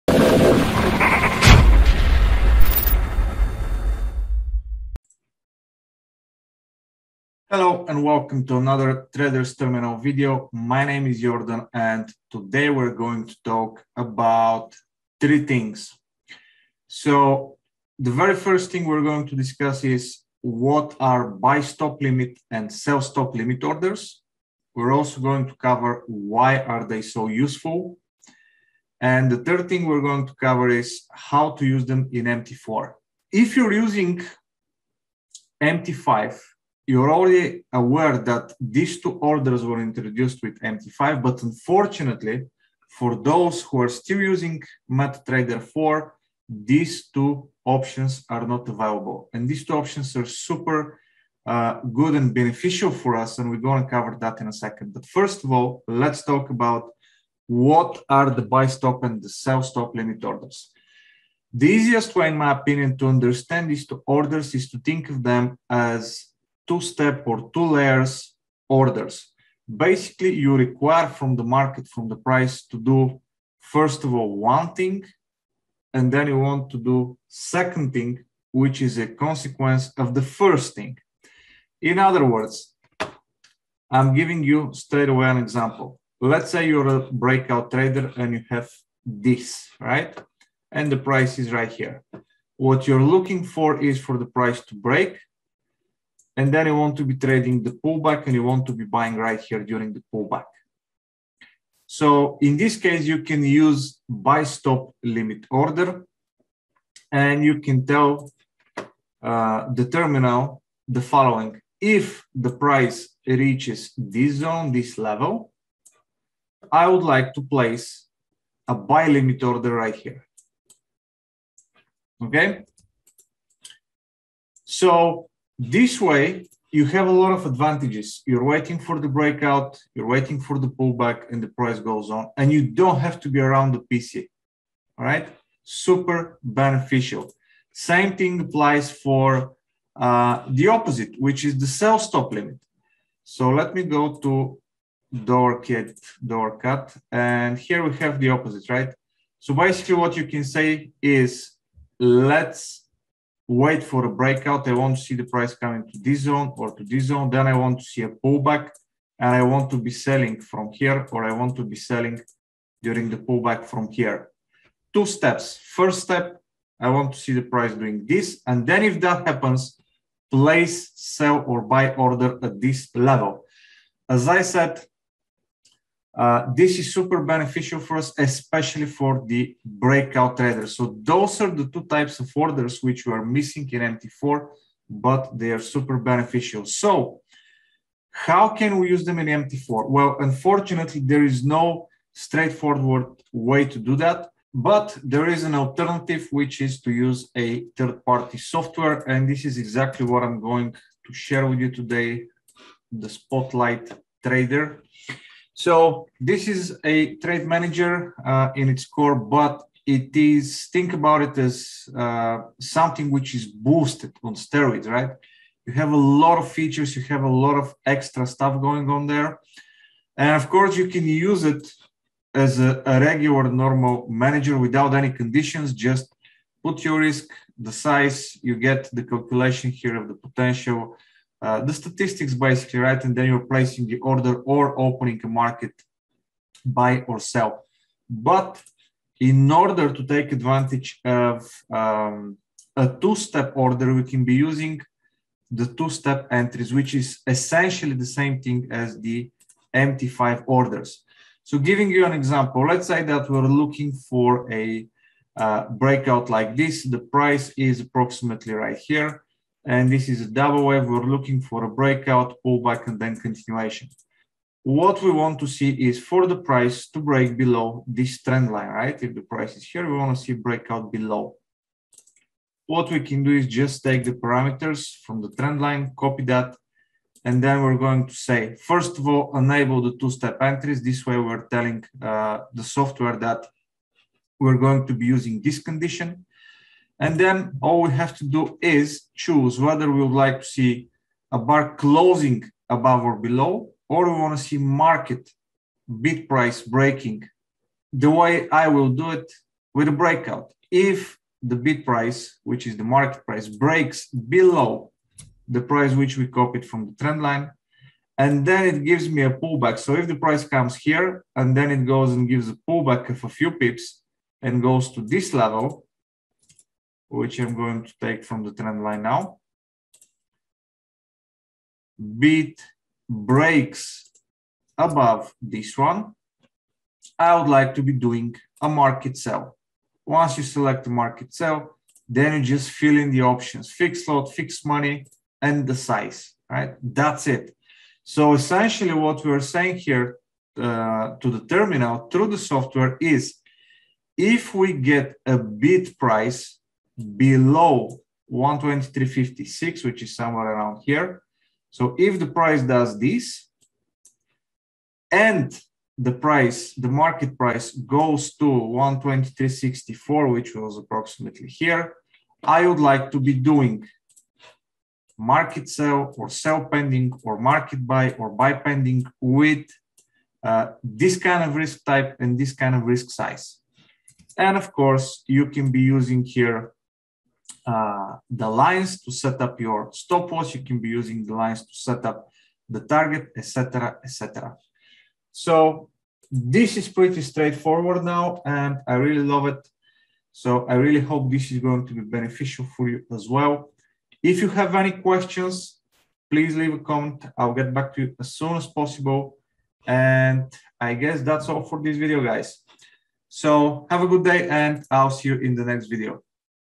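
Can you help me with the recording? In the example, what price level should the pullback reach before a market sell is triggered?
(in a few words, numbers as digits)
123.64.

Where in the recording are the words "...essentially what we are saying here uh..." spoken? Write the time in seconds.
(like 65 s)
338 s.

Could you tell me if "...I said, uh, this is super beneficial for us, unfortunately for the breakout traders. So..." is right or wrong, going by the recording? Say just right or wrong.
wrong.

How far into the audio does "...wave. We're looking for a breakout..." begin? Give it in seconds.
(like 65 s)
260 s.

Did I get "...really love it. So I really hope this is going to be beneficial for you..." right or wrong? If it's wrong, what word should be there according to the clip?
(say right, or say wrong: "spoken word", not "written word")
right.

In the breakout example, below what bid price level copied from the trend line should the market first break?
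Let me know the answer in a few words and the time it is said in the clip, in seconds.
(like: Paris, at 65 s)
123.56, at 348 s.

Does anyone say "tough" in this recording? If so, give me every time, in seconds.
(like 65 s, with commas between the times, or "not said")
not said.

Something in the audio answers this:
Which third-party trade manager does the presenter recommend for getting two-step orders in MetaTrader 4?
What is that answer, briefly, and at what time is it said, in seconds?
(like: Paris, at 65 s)
Spotlight Trader, at 203 s.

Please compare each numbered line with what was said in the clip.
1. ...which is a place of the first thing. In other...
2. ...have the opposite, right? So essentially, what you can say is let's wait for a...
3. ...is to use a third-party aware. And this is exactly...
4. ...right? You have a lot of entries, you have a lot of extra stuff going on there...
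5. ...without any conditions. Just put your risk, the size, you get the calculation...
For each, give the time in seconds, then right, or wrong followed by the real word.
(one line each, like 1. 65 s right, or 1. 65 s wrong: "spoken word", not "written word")
1. 78 s wrong: "consequence", not "place"
2. 147 s wrong: "basically", not "essentially"
3. 196 s wrong: "software", not "aware"
4. 214 s wrong: "features", not "entries"
5. 224 s right.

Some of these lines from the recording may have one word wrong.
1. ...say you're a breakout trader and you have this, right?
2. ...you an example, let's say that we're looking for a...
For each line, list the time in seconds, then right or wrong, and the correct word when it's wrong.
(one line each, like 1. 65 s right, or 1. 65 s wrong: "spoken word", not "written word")
1. 86 s right
2. 251 s right.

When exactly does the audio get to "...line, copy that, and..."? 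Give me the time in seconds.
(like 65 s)
275 s.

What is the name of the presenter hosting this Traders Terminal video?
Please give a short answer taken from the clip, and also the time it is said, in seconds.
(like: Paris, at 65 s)
Jordan, at 11 s.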